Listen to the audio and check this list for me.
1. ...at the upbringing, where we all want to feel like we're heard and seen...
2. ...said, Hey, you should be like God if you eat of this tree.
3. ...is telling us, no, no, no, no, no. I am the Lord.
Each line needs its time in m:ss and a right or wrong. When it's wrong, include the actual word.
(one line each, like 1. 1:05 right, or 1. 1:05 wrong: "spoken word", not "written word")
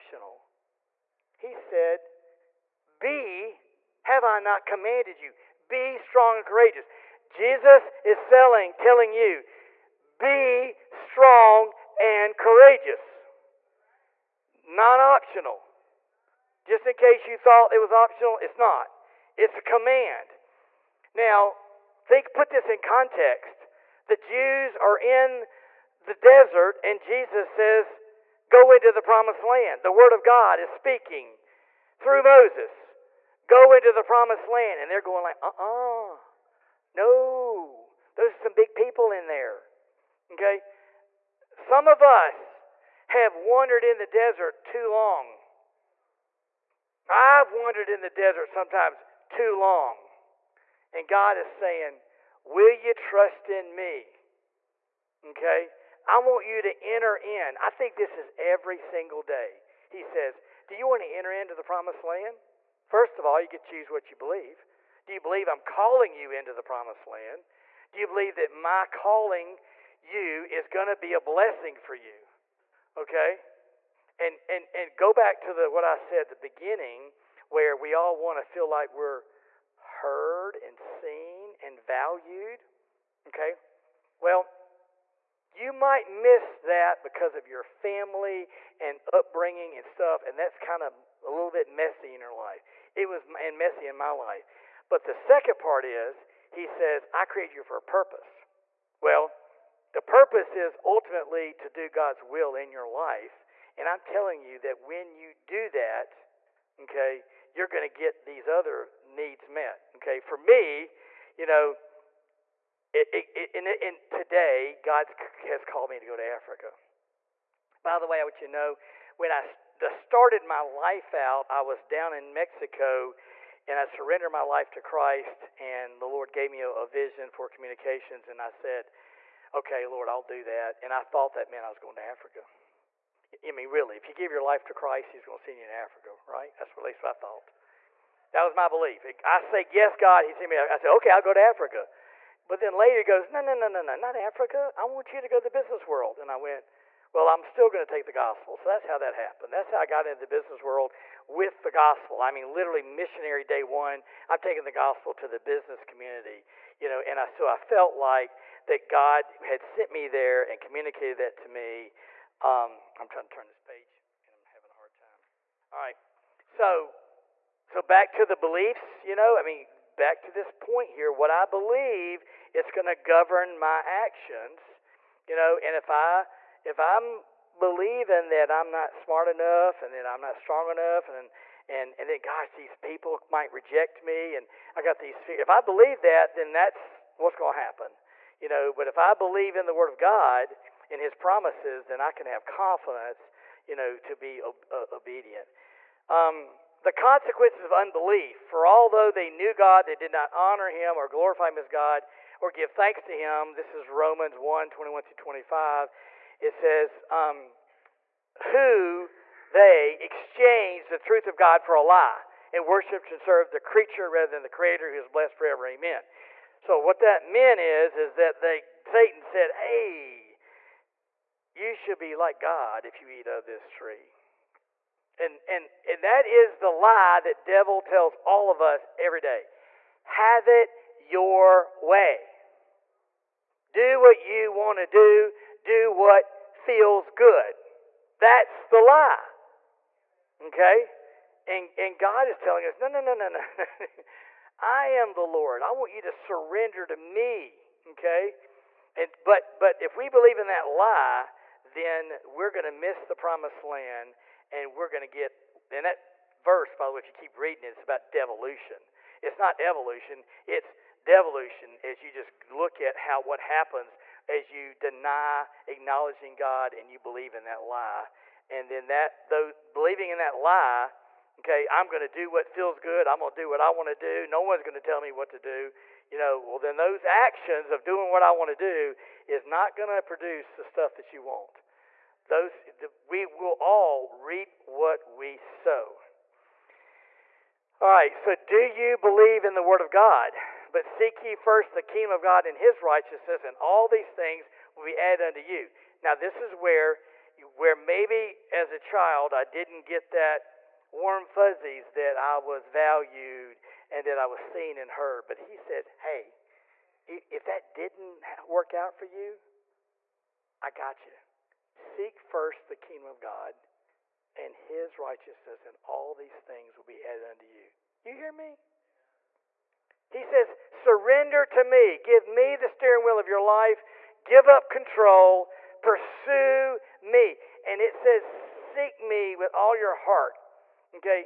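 1. 1:16 wrong: "beginning", not "upbringing"
2. 3:39 right
3. 4:02 right.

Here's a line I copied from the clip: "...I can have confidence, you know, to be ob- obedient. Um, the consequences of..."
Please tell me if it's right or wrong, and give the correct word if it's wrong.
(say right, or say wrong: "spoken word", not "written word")
right.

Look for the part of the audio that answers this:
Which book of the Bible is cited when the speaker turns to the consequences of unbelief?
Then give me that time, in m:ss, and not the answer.
3:23.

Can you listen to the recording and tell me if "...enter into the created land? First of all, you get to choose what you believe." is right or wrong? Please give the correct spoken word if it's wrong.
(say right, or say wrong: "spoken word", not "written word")
wrong: "promised", not "created".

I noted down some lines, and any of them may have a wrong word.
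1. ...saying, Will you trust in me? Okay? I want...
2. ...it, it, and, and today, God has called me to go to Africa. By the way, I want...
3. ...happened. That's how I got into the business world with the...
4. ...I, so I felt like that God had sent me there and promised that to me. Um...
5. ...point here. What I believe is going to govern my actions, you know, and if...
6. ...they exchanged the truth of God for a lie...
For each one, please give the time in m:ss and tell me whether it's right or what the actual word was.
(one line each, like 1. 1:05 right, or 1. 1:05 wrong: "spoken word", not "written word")
1. 0:51 right
2. 1:52 right
3. 2:29 right
4. 2:37 wrong: "communicated", not "promised"
5. 2:50 right
6. 3:29 right.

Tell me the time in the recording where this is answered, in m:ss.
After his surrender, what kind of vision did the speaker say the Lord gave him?
2:07.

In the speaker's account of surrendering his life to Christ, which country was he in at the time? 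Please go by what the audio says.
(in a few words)
Mexico.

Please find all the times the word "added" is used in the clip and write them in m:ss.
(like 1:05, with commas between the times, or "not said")
4:54, 5:17.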